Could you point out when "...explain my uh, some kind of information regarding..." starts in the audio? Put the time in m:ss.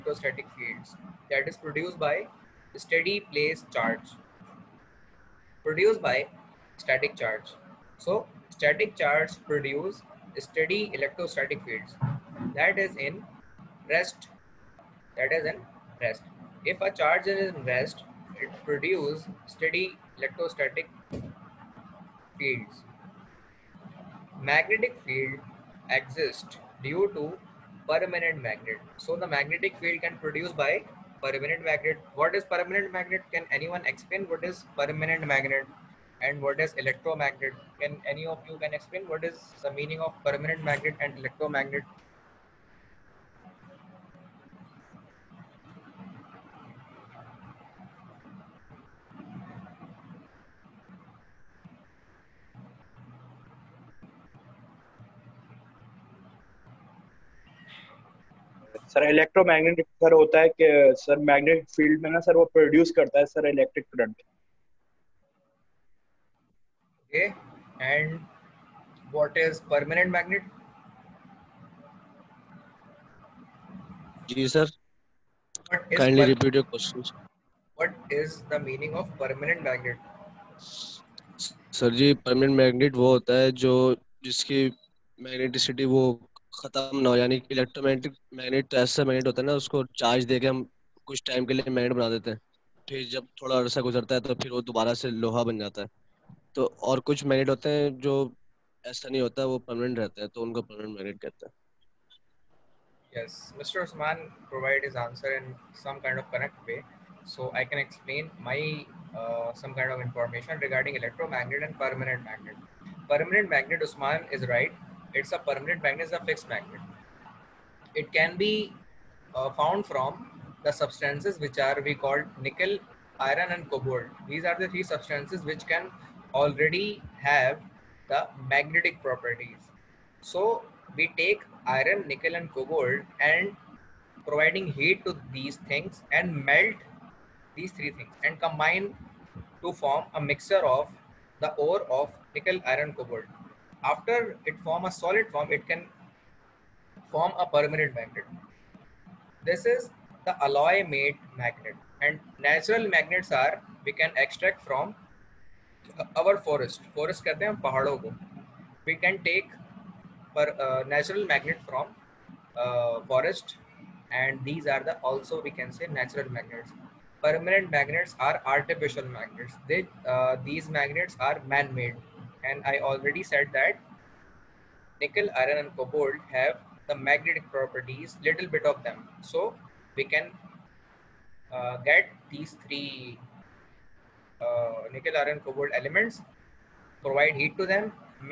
1:47.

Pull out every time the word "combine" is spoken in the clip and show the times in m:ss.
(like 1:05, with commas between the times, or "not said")
2:18.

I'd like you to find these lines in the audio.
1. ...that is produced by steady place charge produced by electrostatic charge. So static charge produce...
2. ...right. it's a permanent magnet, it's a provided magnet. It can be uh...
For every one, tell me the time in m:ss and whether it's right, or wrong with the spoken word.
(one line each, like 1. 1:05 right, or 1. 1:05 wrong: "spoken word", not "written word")
1. 0:01 wrong: "static", not "electrostatic"
2. 1:54 wrong: "fixed", not "provided".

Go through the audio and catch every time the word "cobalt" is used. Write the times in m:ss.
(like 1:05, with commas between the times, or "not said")
2:03, 2:12, 2:22, 2:55, 3:05.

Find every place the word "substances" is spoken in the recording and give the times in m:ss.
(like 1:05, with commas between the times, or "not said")
2:00, 2:04.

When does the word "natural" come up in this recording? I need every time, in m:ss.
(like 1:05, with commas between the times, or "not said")
2:32, 2:40, 2:45.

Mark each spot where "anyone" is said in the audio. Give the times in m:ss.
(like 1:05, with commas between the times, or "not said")
0:33.